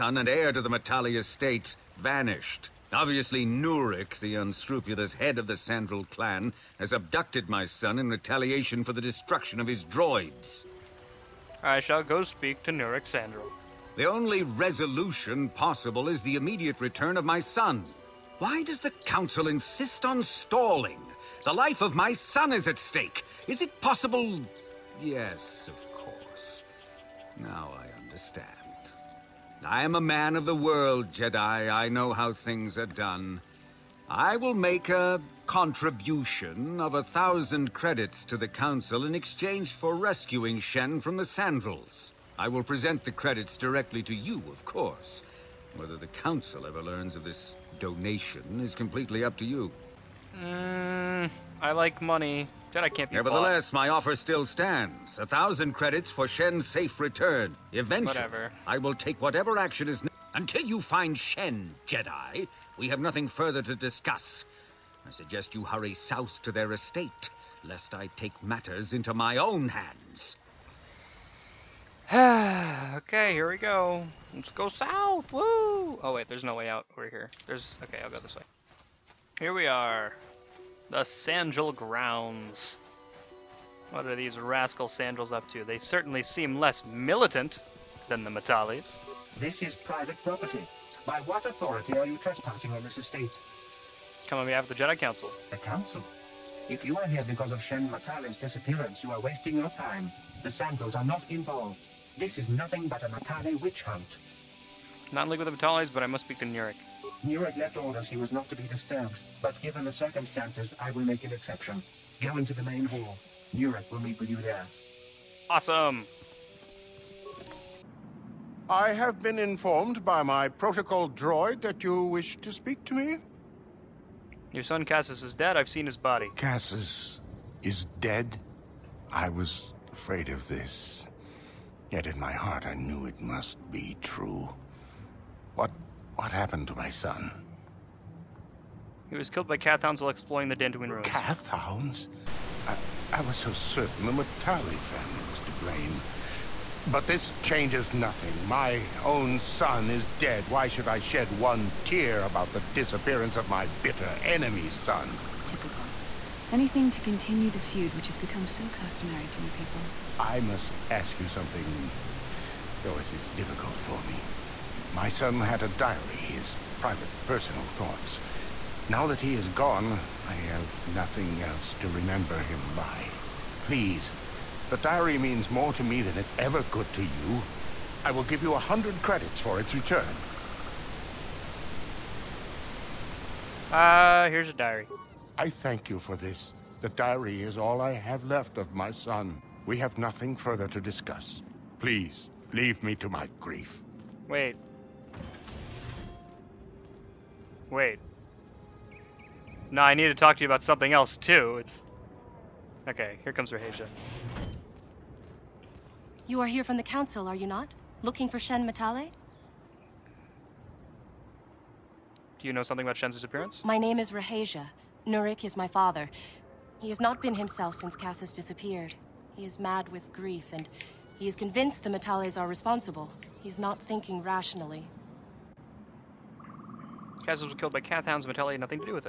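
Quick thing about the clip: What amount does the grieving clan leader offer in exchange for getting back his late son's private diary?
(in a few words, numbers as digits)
100 credits.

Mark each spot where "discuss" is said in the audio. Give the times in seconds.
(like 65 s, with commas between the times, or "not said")
63 s, 190 s.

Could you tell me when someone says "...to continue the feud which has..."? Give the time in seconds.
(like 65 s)
156 s.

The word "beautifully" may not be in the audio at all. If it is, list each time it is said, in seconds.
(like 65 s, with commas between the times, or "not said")
not said.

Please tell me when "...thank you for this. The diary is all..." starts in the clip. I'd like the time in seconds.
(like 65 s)
185 s.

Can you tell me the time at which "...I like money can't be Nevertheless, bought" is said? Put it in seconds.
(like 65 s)
51 s.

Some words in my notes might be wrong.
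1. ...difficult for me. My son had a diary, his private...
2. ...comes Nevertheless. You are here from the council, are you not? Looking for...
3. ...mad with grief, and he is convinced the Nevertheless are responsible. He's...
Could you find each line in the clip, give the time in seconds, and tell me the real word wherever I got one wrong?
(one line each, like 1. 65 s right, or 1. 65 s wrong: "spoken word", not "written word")
1. 163 s right
2. 203 s wrong: "Rahasia", not "Nevertheless"
3. 219 s wrong: "Matales", not "Nevertheless".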